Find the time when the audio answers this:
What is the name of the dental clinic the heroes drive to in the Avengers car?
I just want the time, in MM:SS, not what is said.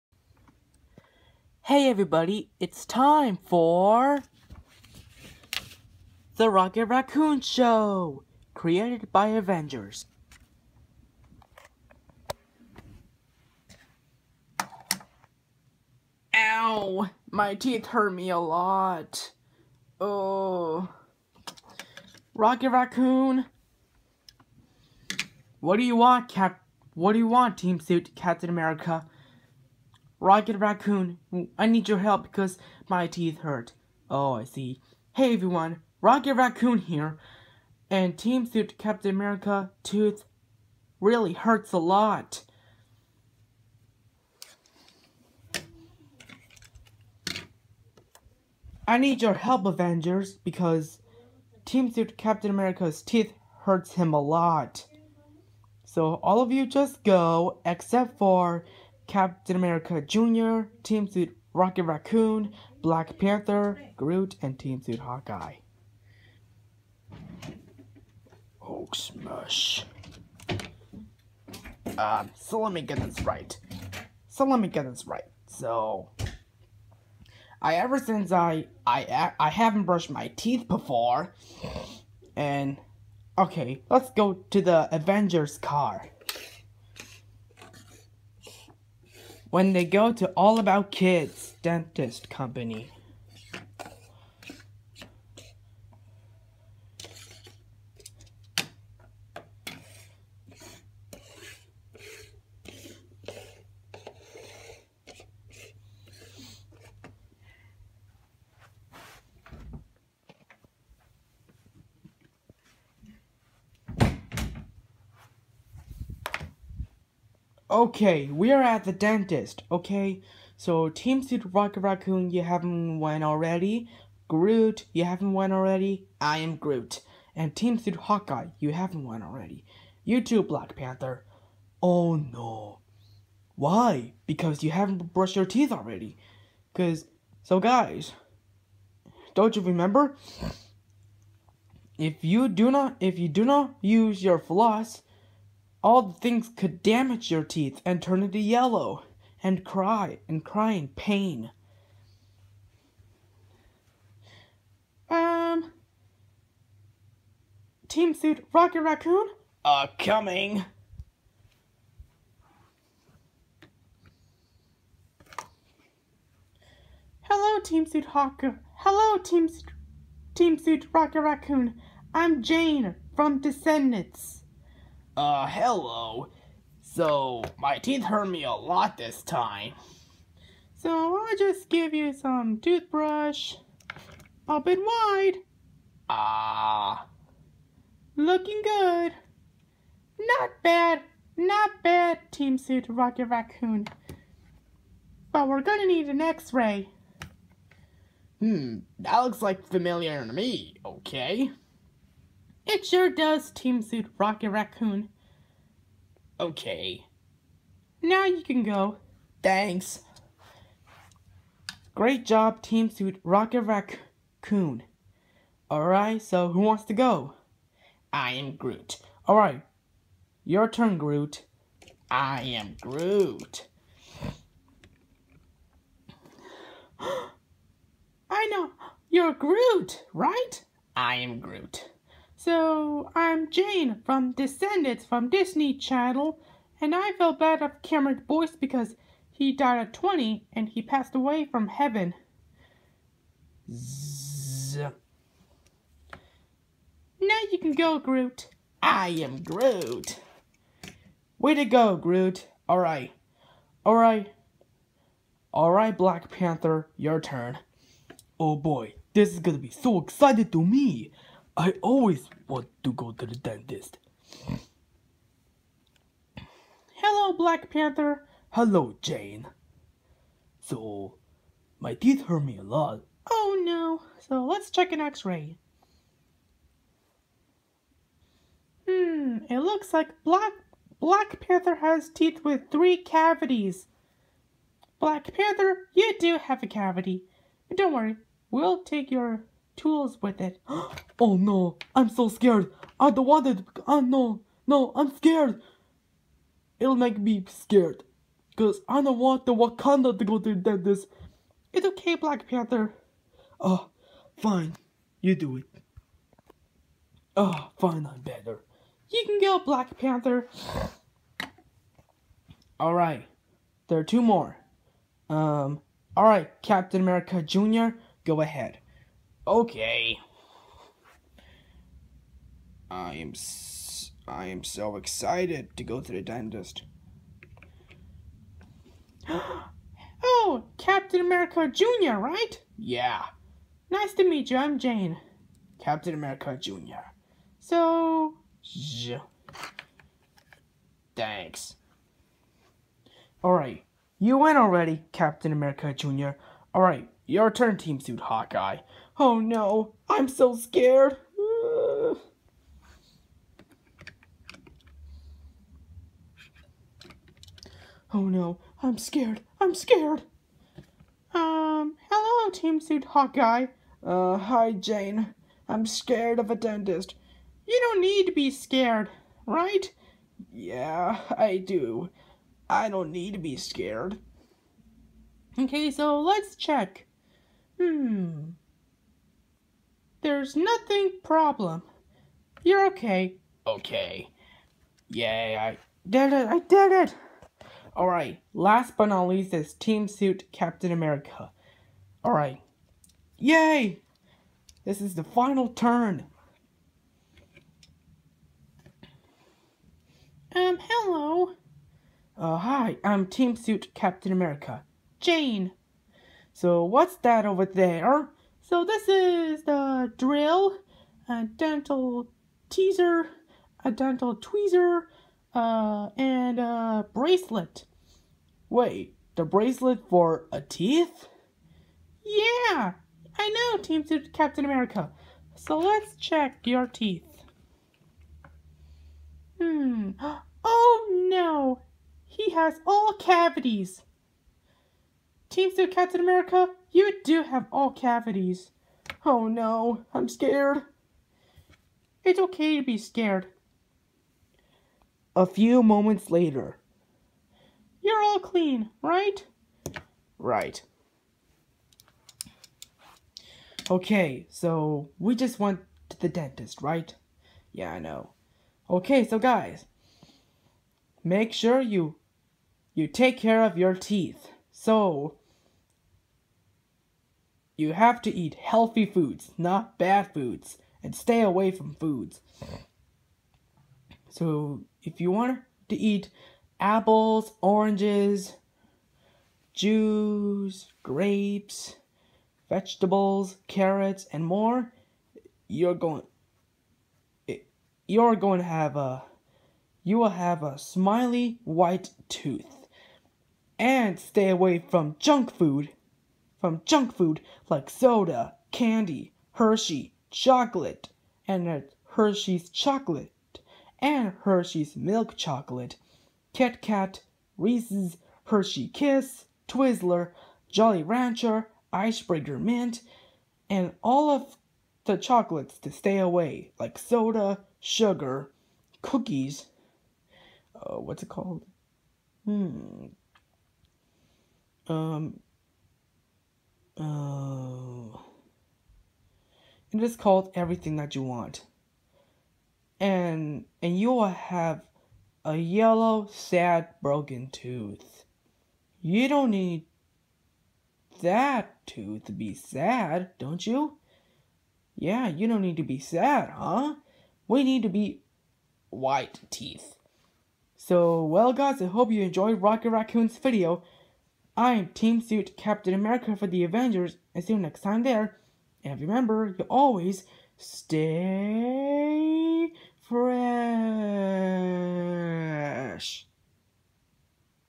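01:30.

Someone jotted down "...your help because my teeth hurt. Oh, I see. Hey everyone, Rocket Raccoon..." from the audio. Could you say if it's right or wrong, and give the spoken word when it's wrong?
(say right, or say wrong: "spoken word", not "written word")
right.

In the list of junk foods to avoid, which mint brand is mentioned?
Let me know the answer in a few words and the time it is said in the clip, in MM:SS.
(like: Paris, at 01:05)
Icebreaker Mint, at 08:31.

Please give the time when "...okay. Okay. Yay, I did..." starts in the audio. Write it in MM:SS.
06:22.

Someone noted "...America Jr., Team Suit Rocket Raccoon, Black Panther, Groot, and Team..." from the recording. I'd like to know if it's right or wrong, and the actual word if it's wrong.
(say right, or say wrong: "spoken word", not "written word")
right.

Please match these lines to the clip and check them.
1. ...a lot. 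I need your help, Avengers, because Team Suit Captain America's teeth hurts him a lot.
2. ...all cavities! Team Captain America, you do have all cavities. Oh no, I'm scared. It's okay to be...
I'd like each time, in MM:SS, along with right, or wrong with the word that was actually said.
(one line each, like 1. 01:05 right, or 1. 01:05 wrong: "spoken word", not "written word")
1. 00:41 right
2. 07:12 right.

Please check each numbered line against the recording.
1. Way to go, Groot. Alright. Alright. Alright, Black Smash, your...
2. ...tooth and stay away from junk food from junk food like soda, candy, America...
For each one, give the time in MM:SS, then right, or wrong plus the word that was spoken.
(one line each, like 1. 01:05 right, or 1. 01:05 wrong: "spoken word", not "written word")
1. 04:11 wrong: "Panther", not "Smash"
2. 08:12 wrong: "Hershey", not "America".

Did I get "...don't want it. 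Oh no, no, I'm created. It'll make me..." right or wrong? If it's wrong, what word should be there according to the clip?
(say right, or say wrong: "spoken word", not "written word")
wrong: "scared", not "created".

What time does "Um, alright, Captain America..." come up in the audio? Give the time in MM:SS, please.
05:15.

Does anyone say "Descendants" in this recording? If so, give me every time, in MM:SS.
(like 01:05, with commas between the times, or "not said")
02:53, 03:54.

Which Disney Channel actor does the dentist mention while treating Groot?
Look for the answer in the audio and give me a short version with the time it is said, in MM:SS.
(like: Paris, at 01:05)
Cameron Boyce, at 03:57.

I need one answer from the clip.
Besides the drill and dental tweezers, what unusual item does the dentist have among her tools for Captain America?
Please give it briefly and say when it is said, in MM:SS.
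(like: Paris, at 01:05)
A bracelet, at 06:56.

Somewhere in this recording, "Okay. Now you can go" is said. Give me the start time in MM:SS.
03:26.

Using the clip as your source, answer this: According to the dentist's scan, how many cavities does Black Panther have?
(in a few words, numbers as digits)
3.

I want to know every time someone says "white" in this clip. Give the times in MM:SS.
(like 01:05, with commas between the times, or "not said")
08:11, 09:08.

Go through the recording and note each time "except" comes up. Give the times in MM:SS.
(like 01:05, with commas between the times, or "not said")
00:57.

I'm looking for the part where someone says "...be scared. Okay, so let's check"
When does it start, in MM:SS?
06:13.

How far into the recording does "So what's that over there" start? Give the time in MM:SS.
06:46.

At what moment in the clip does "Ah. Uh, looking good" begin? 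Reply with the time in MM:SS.
03:06.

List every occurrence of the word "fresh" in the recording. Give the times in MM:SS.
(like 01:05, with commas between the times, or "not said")
09:22.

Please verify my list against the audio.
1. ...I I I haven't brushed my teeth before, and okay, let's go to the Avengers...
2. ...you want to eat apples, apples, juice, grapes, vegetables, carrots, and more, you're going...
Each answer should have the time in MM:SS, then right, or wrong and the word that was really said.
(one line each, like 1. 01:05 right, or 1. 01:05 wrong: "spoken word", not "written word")
1. 01:18 right
2. 07:55 wrong: "oranges", not "apples".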